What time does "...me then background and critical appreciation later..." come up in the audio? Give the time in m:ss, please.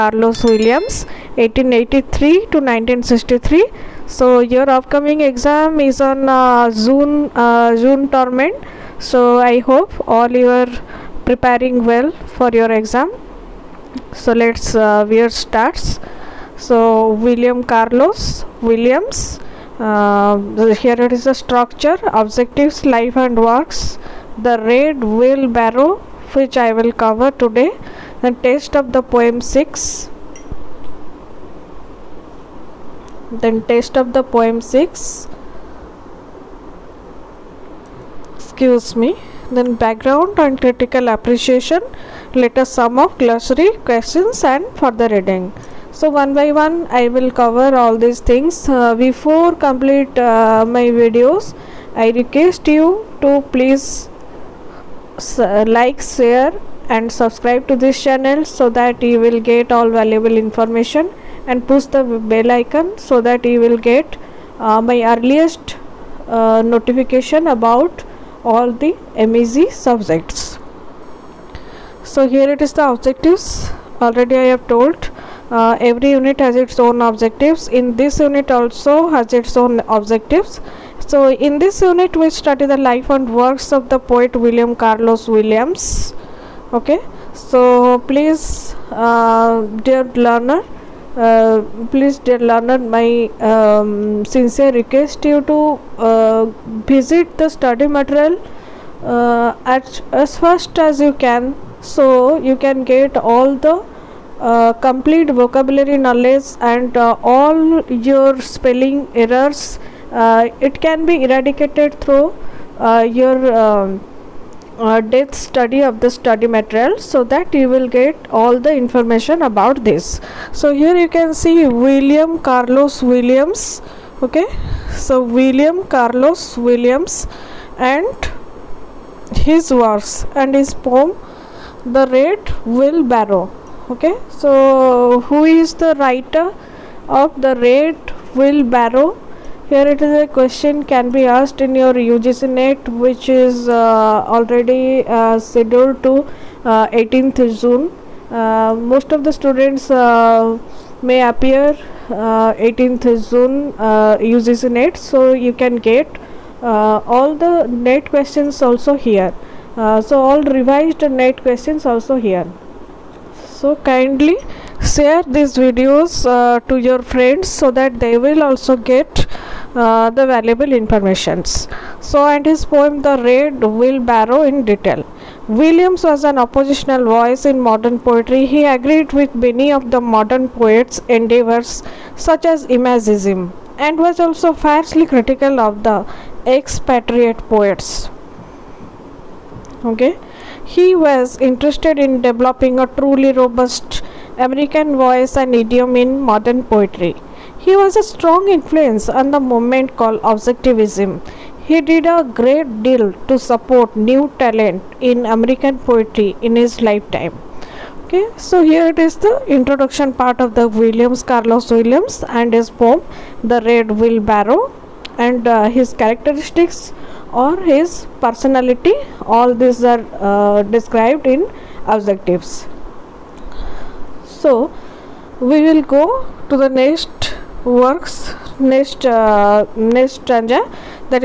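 0:38.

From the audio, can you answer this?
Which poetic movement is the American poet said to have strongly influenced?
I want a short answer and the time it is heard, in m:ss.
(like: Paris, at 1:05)
Objectivism, at 3:20.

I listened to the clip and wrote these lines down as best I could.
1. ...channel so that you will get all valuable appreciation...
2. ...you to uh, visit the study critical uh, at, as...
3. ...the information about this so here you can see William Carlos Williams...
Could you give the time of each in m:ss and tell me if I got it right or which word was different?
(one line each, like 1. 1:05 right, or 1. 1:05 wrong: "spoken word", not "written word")
1. 0:58 wrong: "information", not "appreciation"
2. 1:35 wrong: "material", not "critical"
3. 1:58 right.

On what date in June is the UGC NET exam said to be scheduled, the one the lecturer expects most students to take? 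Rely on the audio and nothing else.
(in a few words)
18th June.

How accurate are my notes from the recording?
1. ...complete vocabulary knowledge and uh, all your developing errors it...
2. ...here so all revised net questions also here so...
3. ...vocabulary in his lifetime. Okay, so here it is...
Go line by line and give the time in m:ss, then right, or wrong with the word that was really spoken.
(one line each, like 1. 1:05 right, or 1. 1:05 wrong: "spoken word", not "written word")
1. 1:44 wrong: "spelling", not "developing"
2. 2:38 right
3. 3:25 wrong: "poetry", not "vocabulary".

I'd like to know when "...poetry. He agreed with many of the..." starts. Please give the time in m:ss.
2:57.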